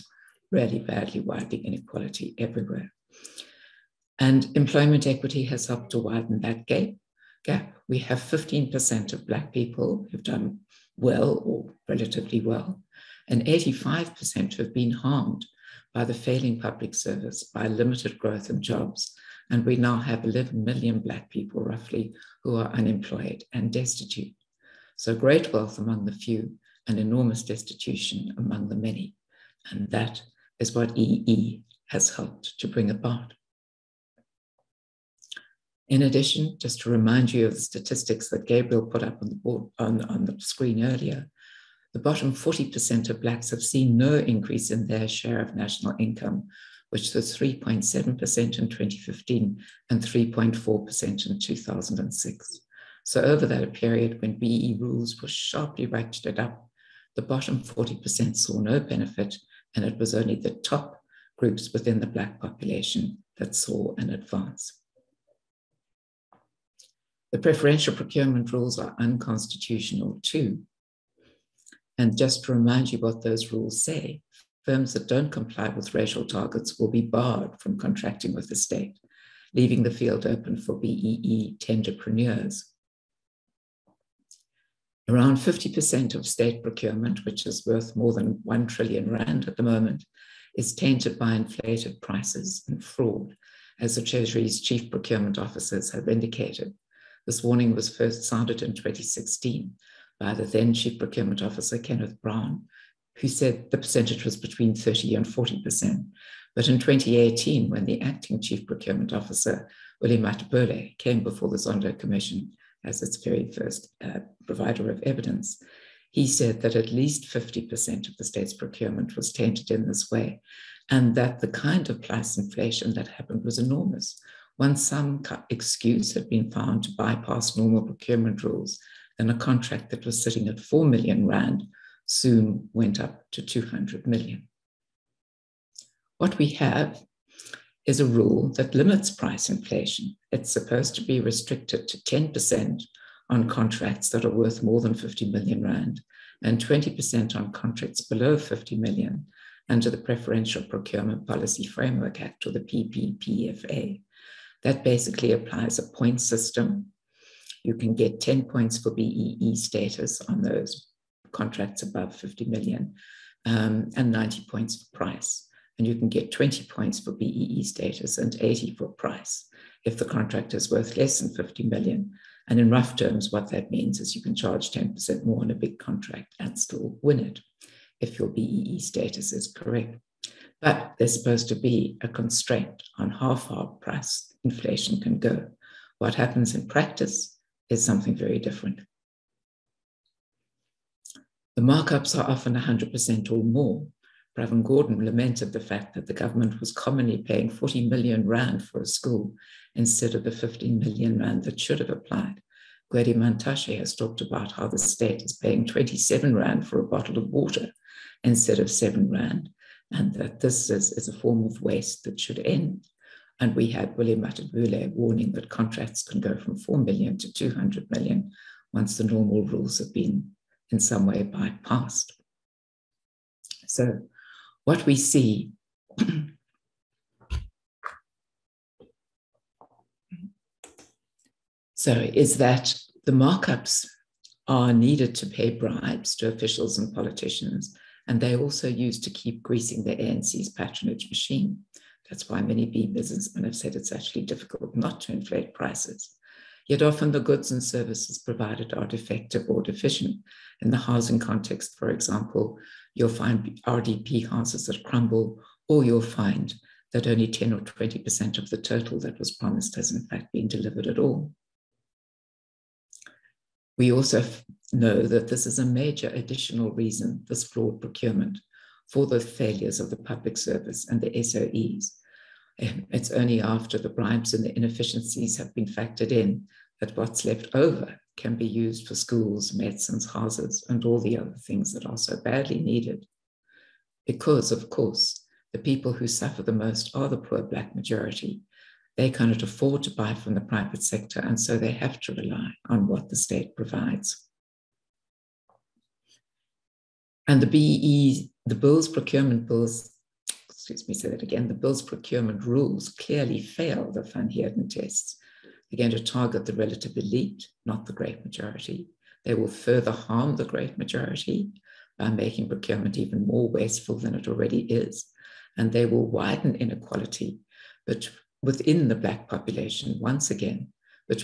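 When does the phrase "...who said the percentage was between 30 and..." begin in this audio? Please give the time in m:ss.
1:43.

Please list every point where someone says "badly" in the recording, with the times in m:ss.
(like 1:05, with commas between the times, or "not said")
0:00, 4:42.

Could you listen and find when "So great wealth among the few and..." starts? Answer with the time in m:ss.
0:24.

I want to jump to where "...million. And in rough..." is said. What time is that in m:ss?
2:51.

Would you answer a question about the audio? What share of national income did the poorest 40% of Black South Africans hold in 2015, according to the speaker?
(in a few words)
3.7%.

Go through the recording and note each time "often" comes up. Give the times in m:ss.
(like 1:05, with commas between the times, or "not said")
3:12, 4:06.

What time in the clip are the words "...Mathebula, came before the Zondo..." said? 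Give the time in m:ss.
1:50.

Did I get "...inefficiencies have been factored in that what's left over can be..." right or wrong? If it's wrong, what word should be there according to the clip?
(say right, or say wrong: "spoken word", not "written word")
right.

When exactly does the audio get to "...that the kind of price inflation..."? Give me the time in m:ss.
2:01.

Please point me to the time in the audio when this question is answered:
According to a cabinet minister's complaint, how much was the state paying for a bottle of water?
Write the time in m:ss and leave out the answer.
3:25.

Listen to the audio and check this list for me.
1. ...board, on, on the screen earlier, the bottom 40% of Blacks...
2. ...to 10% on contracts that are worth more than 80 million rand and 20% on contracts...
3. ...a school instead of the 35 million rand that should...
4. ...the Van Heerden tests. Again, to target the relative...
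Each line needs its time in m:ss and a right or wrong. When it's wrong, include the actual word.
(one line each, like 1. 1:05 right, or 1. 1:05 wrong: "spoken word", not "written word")
1. 0:39 right
2. 2:21 wrong: "50", not "80"
3. 3:18 wrong: "15", not "35"
4. 5:03 right.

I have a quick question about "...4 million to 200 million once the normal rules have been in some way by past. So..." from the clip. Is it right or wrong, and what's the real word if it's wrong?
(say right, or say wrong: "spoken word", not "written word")
right.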